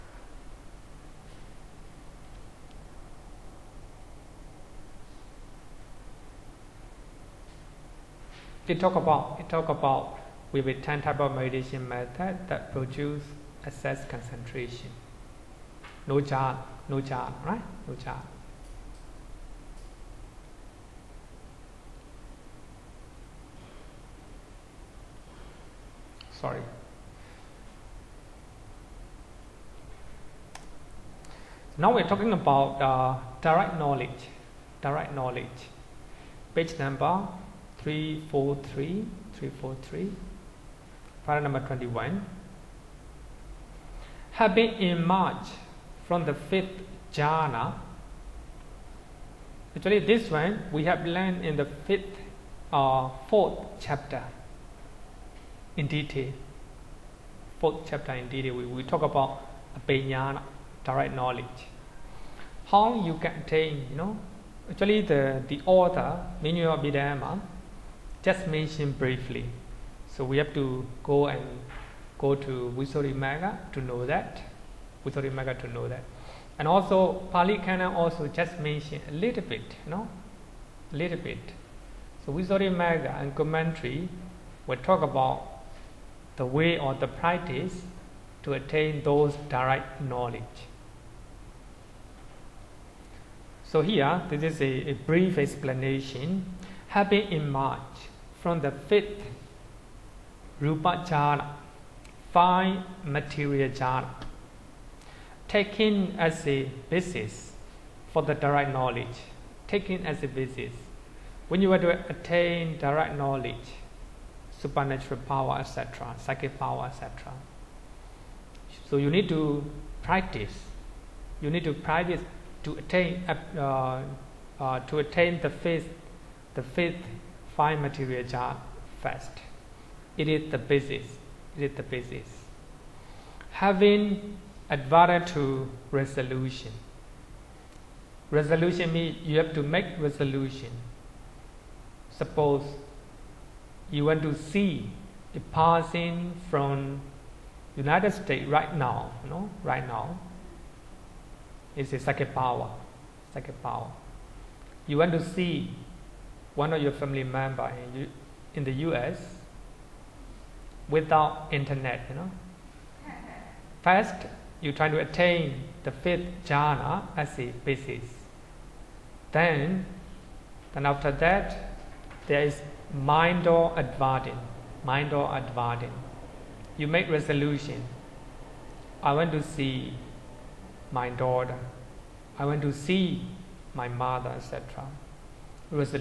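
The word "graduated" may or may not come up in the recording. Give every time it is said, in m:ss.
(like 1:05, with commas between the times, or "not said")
not said.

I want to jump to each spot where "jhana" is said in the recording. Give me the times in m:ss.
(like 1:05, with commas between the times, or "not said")
0:47, 1:43, 2:08, 2:46.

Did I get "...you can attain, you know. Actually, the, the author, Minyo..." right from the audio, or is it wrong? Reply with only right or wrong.
right.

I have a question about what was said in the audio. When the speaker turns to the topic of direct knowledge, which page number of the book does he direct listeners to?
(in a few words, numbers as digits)
343.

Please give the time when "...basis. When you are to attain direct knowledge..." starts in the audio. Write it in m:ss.
1:50.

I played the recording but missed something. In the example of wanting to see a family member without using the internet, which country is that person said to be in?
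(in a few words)
United States.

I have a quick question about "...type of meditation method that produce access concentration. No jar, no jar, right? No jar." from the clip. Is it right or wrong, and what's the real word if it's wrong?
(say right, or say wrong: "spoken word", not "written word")
right.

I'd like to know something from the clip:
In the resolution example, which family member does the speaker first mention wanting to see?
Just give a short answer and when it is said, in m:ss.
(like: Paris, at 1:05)
Daughter, at 3:00.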